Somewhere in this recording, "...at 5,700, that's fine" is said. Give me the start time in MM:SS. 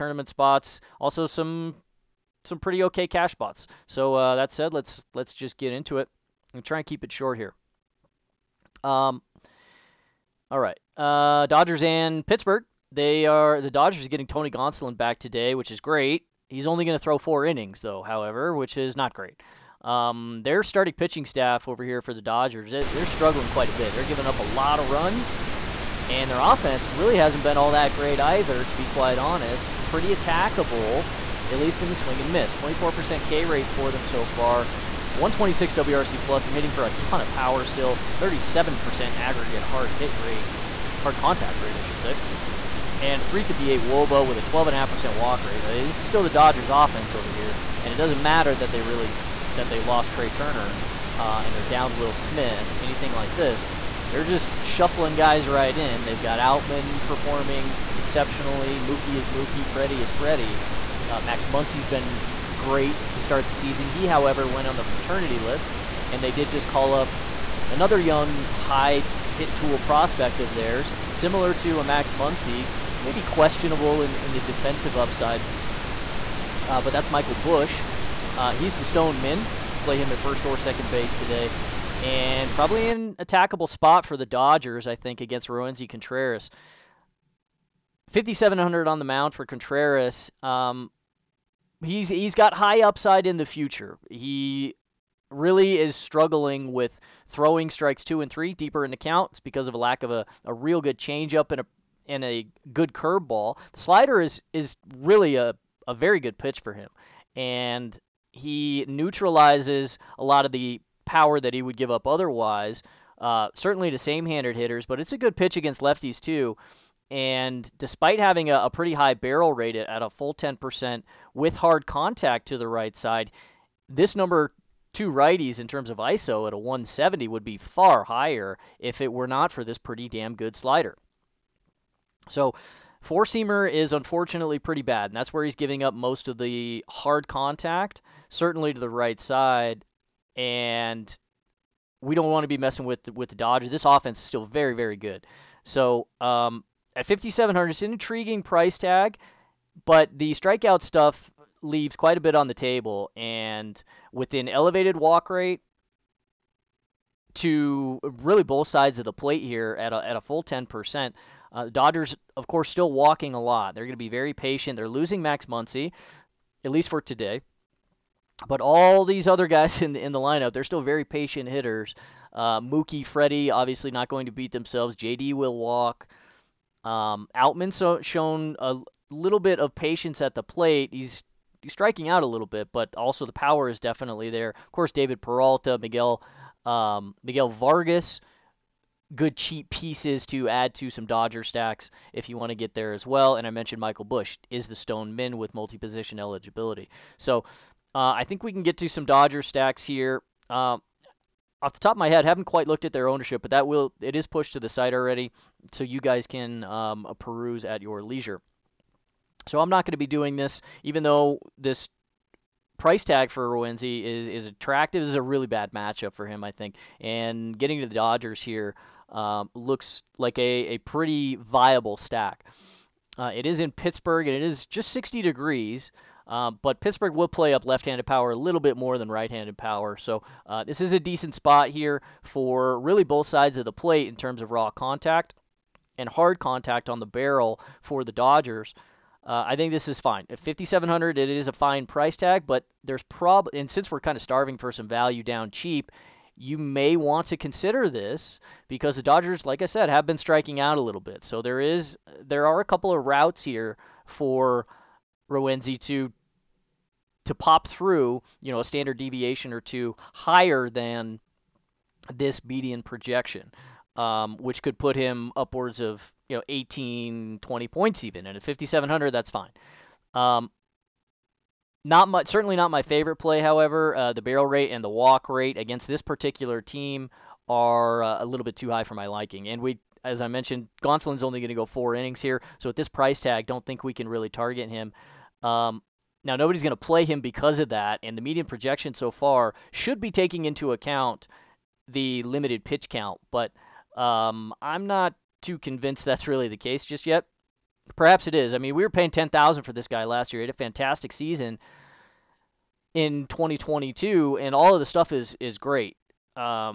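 04:28.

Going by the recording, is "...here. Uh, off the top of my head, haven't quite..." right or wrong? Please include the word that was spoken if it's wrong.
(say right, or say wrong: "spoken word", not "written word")
right.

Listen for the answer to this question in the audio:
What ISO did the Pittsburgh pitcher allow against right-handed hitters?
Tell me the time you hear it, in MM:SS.
02:06.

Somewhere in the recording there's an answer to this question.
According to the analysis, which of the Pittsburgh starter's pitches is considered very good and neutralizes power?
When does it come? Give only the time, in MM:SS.
01:43.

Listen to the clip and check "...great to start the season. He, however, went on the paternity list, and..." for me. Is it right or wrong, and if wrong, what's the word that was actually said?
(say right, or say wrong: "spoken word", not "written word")
right.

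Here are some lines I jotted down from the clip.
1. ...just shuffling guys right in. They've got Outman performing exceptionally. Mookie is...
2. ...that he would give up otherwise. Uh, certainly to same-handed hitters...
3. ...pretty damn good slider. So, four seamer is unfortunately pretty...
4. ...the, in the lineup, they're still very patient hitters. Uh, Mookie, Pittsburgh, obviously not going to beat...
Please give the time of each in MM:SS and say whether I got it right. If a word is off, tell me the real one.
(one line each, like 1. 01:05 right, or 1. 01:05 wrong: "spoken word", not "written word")
1. 00:54 right
2. 01:51 right
3. 02:09 right
4. 02:49 wrong: "Freddie", not "Pittsburgh".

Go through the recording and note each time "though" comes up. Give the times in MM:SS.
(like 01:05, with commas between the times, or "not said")
00:17, 03:31.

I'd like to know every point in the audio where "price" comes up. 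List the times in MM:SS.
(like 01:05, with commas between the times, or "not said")
02:28, 03:32, 04:01, 04:42.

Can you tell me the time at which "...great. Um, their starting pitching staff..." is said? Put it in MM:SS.
00:19.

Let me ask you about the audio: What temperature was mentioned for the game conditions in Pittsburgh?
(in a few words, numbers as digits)
60 degrees.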